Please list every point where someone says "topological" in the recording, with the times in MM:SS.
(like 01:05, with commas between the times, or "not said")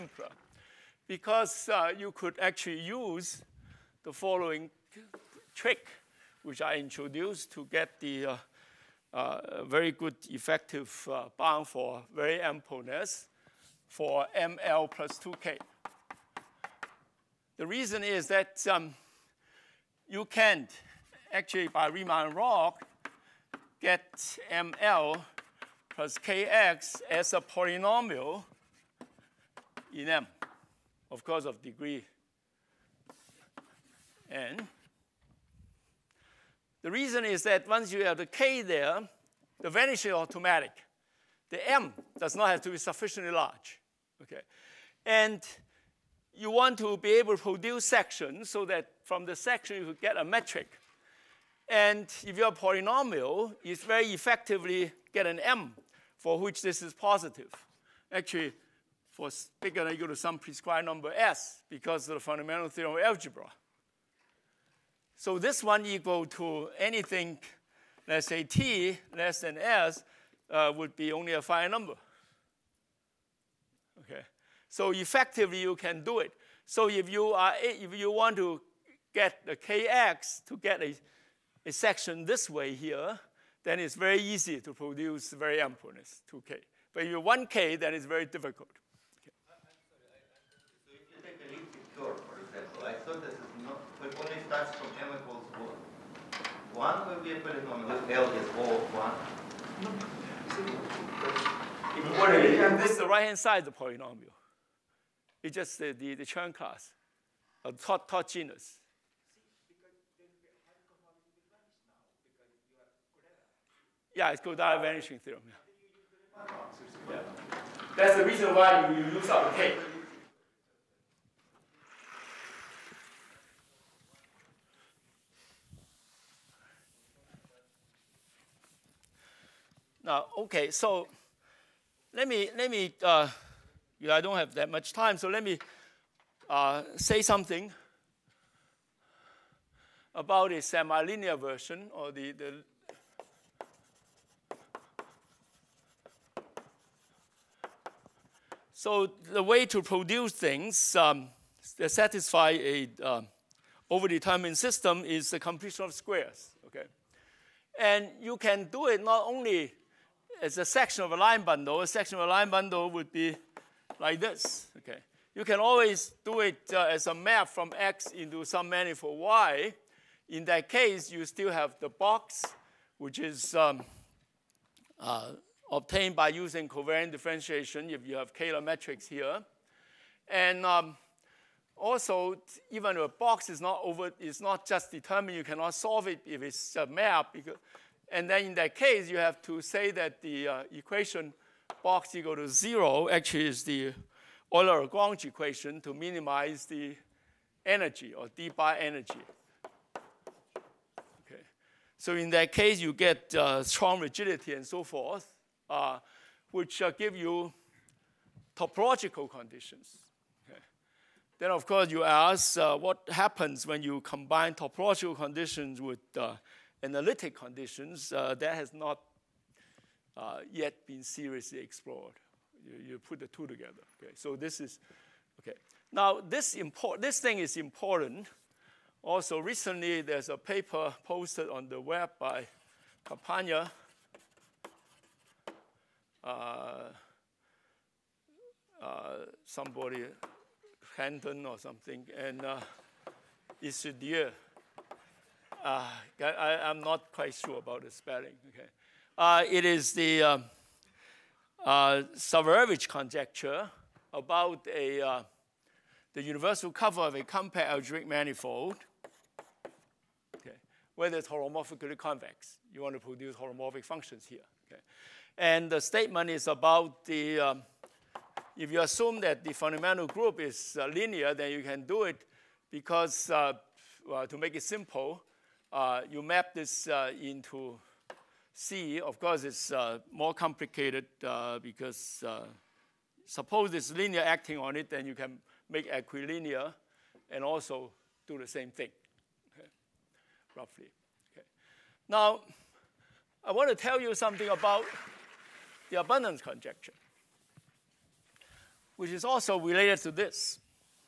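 03:28, 03:34.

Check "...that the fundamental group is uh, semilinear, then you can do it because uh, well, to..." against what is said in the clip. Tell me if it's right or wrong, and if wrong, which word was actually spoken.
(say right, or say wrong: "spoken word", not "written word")
wrong: "linear", not "semilinear".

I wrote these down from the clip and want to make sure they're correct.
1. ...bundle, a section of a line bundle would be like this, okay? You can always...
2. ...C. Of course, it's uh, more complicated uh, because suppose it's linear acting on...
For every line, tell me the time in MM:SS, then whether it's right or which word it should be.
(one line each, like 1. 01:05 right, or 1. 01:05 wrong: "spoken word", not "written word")
1. 02:41 right
2. 04:38 right.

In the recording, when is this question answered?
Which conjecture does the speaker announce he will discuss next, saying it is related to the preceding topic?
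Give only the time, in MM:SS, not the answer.
04:56.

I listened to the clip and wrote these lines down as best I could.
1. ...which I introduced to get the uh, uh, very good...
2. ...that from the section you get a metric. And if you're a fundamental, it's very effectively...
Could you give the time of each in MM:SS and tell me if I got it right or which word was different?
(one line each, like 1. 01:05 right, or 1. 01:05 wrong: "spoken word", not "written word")
1. 00:06 right
2. 00:48 wrong: "polynomial", not "fundamental".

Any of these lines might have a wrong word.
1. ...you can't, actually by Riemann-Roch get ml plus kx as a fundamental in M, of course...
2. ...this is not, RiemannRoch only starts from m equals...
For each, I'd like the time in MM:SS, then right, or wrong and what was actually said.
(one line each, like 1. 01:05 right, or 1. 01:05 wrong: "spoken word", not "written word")
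1. 00:20 wrong: "polynomial", not "fundamental"
2. 01:33 wrong: "But", not "RiemannRoch".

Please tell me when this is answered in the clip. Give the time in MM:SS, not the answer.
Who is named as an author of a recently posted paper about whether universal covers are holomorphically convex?
03:53.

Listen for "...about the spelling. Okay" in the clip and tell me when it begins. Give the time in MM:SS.
04:07.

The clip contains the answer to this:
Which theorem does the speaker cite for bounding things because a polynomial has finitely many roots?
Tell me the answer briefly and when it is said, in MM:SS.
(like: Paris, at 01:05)
fundamental theorem of algebra, at 01:02.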